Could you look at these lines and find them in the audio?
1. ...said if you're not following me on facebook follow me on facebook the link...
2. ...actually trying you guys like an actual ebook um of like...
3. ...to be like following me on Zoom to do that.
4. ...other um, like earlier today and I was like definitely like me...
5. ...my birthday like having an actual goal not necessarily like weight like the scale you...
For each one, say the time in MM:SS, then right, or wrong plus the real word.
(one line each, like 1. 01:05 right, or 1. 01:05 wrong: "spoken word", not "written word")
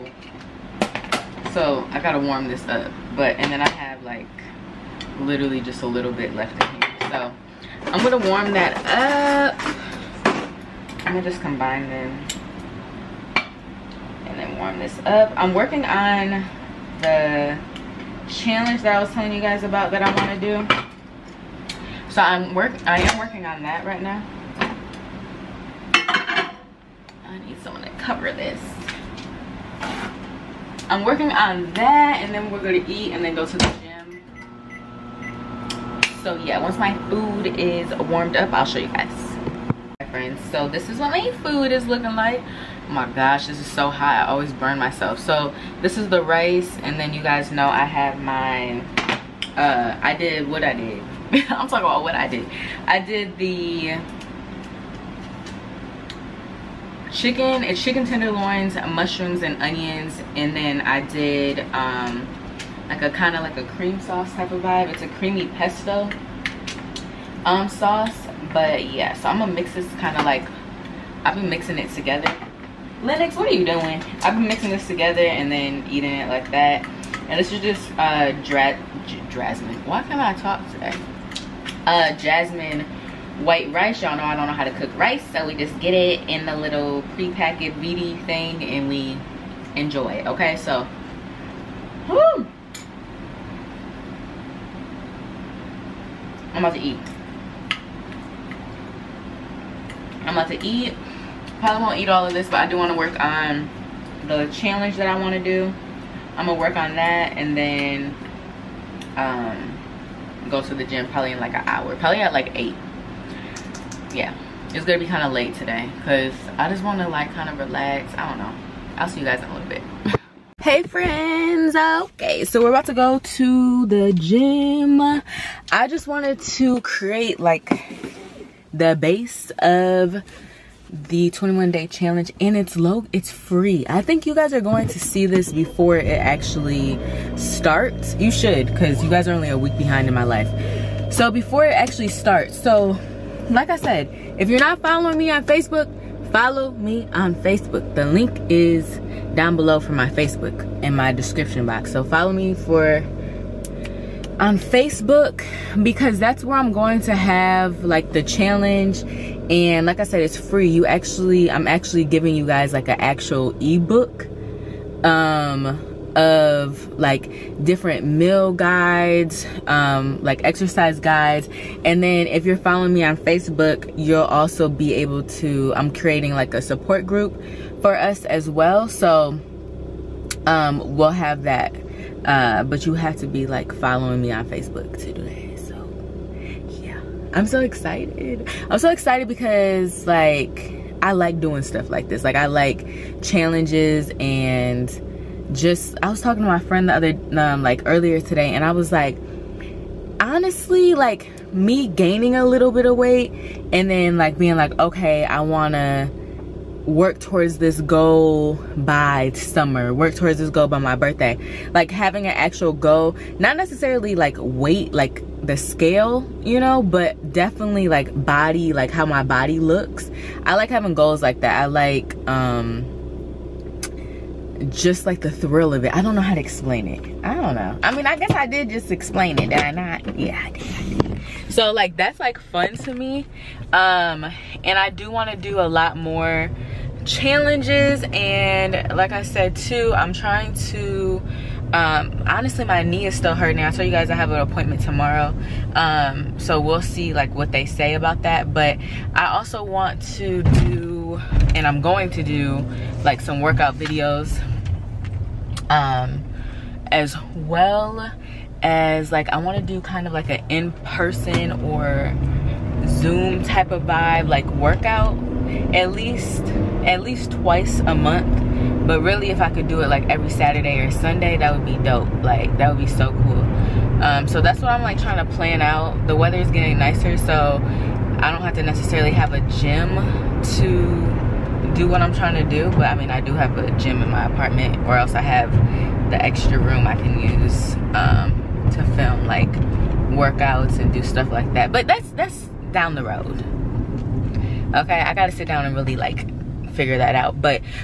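1. 02:23 right
2. 02:41 wrong: "giving", not "trying"
3. 03:03 wrong: "Facebook", not "Zoom"
4. 03:16 wrong: "honestly", not "definitely"
5. 03:30 right.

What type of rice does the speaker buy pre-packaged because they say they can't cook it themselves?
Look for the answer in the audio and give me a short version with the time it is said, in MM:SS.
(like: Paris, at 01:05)
Jasmine white rice, at 01:22.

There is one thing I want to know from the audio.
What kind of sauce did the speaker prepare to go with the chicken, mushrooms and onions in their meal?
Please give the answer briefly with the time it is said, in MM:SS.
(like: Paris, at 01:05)
Creamy pesto, at 01:05.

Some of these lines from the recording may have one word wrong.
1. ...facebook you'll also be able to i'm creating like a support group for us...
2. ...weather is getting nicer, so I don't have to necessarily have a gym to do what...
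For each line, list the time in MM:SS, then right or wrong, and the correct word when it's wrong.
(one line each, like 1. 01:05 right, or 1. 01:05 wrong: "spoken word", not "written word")
1. 02:53 right
2. 04:36 right.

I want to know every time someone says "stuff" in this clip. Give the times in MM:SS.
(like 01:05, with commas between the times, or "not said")
03:11, 04:51.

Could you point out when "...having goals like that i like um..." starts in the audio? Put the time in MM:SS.
03:40.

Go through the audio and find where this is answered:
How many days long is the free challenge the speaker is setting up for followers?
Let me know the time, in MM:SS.
02:11.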